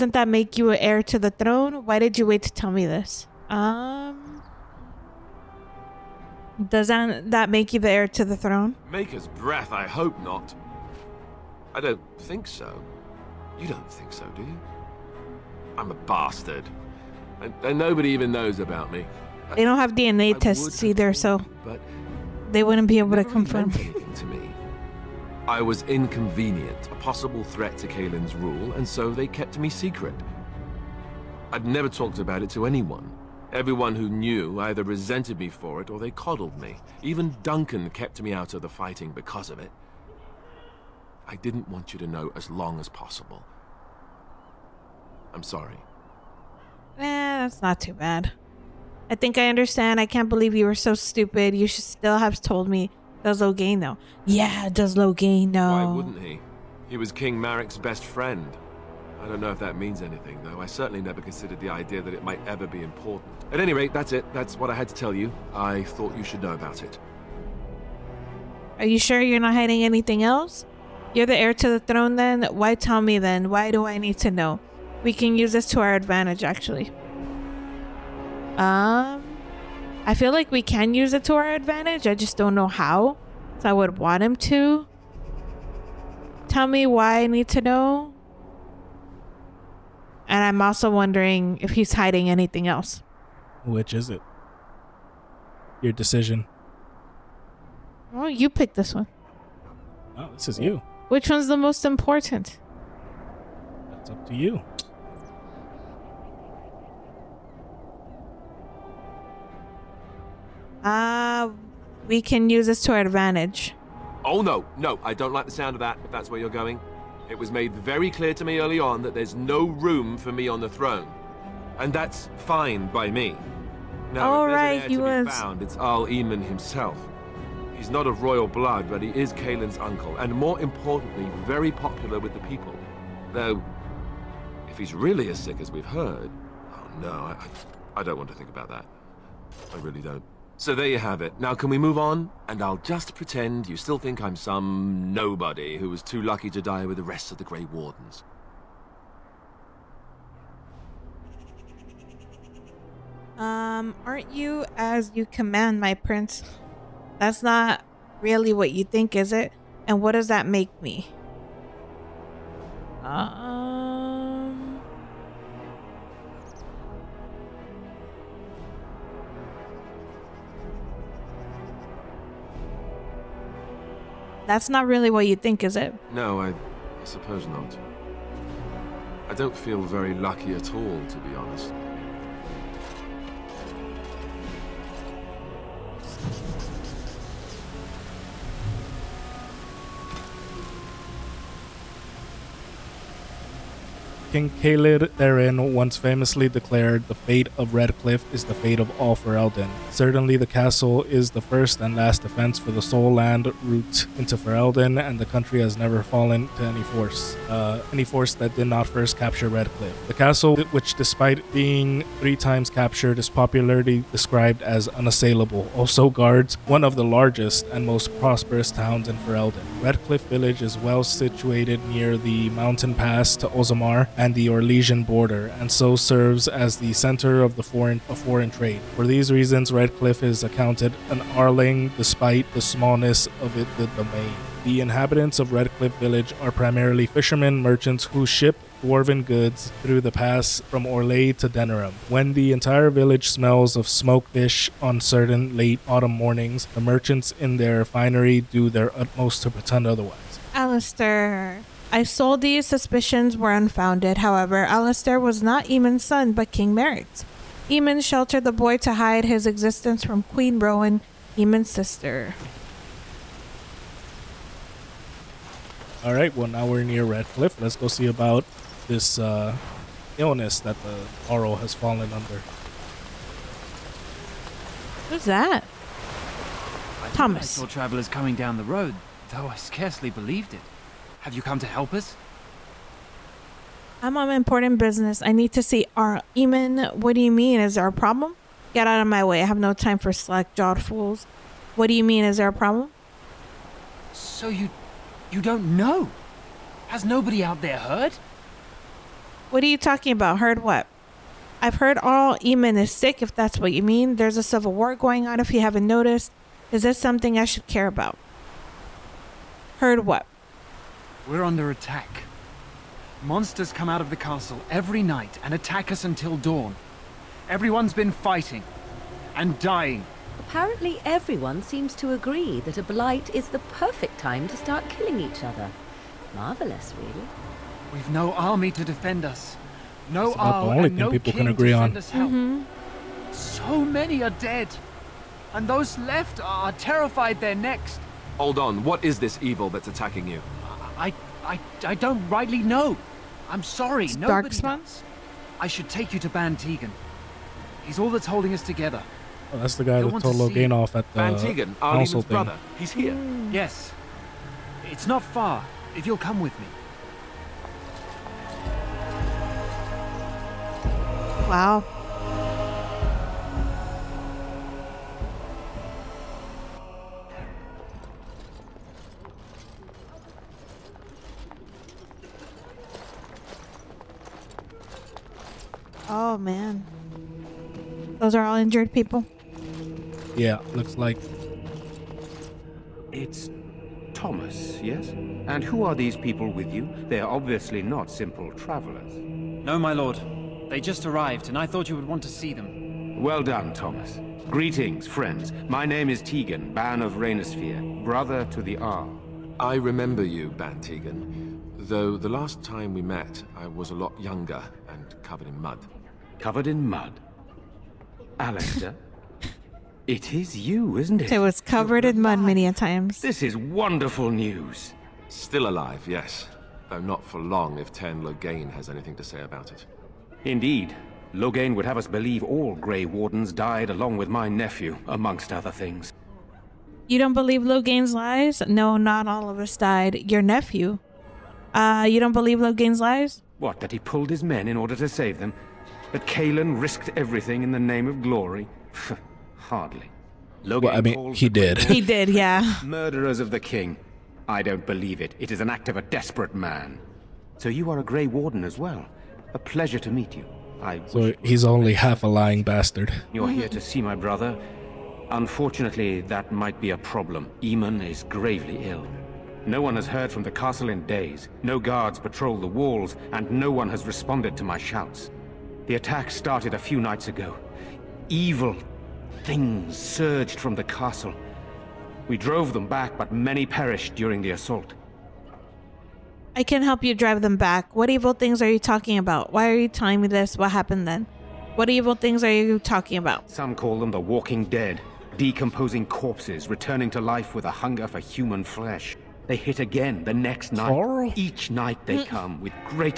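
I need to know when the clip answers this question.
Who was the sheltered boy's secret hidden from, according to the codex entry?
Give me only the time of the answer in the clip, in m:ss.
4:20.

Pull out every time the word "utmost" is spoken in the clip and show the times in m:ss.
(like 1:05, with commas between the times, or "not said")
4:08.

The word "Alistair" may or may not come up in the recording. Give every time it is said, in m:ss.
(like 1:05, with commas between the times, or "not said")
4:10, 4:14.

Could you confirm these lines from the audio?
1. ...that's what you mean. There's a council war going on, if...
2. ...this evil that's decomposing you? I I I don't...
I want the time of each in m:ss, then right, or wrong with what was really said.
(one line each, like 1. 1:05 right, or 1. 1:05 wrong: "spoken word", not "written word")
1. 5:03 wrong: "civil", not "council"
2. 5:39 wrong: "attacking", not "decomposing".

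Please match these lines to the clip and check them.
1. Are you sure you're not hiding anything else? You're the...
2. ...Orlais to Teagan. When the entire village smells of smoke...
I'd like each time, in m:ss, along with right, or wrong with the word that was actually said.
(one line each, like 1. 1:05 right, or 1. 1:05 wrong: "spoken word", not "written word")
1. 1:08 right
2. 4:00 wrong: "Denerim", not "Teagan".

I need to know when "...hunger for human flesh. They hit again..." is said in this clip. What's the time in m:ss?
8:07.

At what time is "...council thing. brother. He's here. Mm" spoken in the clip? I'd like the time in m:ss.
5:51.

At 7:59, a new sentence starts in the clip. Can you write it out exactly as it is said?
Why are you telling me this?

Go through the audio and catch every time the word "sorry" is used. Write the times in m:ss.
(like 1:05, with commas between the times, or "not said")
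0:45, 5:43.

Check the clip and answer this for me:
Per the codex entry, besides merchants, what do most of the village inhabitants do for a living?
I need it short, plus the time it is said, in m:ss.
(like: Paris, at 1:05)
Fishermen, at 3:57.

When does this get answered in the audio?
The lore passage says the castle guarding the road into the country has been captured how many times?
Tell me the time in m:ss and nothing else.
3:32.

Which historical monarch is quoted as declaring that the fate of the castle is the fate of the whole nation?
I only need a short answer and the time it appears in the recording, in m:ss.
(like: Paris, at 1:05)
King Caelid, at 3:14.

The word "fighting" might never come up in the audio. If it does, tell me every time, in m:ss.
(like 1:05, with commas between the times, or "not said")
0:38, 5:18.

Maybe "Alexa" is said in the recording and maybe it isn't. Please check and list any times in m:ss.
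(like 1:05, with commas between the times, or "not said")
6:48.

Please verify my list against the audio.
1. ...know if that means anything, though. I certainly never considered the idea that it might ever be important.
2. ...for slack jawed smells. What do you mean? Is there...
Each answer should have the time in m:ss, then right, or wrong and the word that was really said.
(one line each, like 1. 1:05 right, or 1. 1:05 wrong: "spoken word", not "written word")
1. 0:59 right
2. 4:49 wrong: "fools", not "smells".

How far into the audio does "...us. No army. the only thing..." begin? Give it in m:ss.
5:29.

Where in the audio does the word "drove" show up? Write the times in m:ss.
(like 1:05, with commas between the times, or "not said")
7:52.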